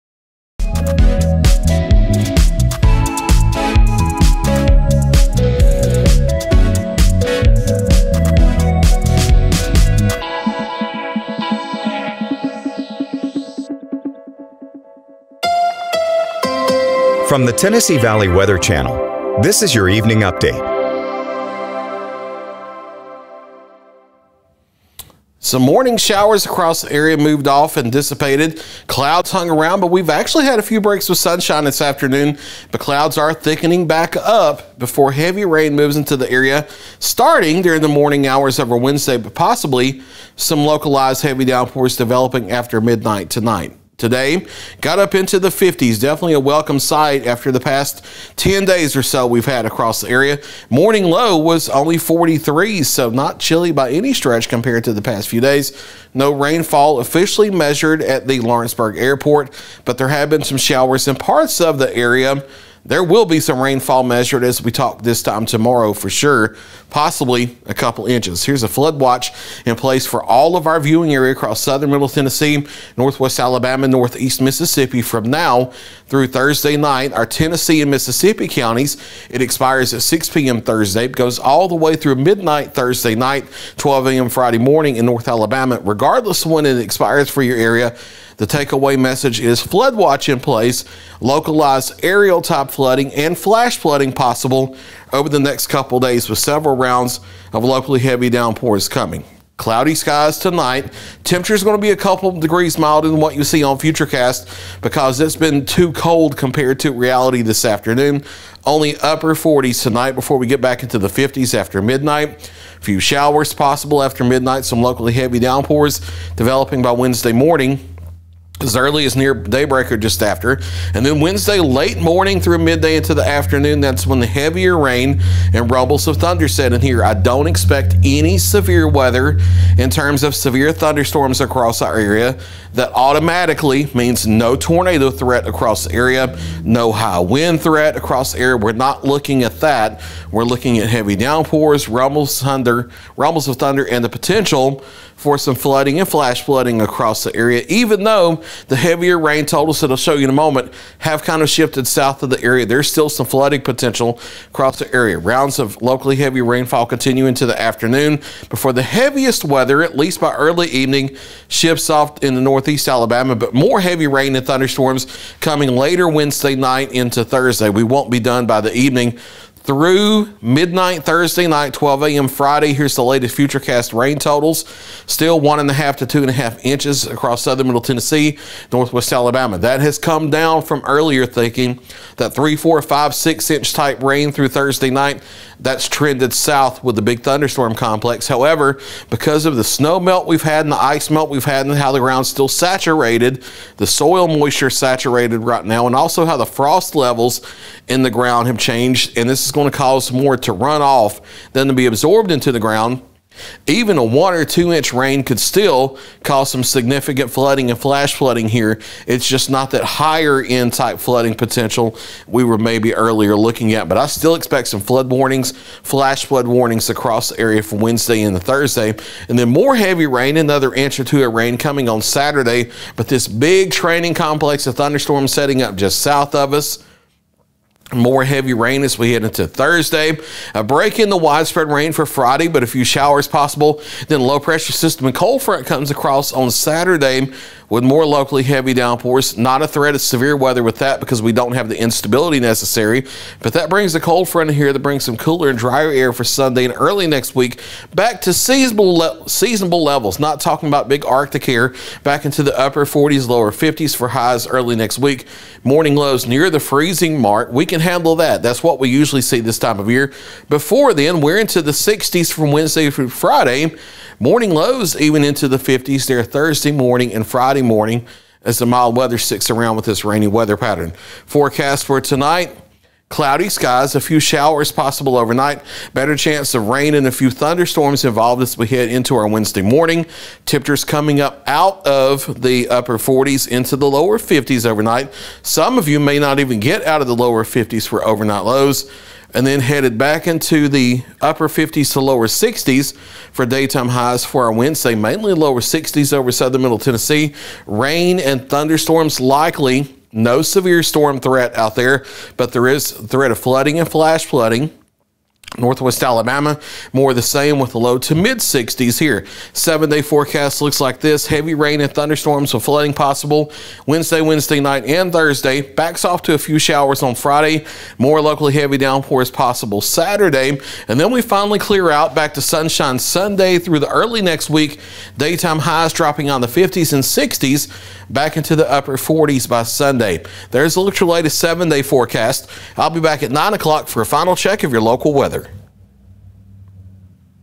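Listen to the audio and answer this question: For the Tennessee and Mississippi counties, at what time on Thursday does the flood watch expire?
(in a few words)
6 p.m.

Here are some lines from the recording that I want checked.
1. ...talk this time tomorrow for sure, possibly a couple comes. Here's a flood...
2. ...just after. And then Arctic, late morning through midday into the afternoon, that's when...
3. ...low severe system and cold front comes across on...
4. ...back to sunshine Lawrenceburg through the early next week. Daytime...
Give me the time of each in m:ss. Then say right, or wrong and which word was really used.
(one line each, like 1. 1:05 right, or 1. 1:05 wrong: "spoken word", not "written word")
1. 1:04 wrong: "inches", not "comes"
2. 1:59 wrong: "Wednesday", not "Arctic"
3. 3:54 wrong: "pressure", not "severe"
4. 5:22 wrong: "Sunday", not "Lawrenceburg".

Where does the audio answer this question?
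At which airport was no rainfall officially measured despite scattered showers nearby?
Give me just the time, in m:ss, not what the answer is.
0:58.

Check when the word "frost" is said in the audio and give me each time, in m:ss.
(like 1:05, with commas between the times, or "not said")
3:16.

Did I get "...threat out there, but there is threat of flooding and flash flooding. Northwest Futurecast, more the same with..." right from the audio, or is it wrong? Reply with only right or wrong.
wrong.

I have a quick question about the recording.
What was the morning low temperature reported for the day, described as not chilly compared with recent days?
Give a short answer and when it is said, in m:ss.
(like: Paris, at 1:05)
43, at 0:51.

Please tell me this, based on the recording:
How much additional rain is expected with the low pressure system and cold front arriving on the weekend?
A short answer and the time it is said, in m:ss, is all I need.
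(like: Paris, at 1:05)
1 or 2 inches, at 3:40.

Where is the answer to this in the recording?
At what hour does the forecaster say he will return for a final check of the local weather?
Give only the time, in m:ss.
5:33.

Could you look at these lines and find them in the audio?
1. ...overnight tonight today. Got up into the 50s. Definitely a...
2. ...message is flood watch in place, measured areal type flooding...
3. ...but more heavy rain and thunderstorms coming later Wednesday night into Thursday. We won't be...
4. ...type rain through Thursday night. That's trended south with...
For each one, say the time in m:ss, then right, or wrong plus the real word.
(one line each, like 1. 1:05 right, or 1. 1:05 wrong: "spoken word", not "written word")
1. 0:42 wrong: "midnight", not "overnight"
2. 1:28 wrong: "localized", not "measured"
3. 2:43 right
4. 3:03 right.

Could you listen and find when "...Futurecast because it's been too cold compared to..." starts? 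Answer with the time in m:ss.
1:43.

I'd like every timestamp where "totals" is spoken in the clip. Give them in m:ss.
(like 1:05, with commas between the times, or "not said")
2:29, 2:54.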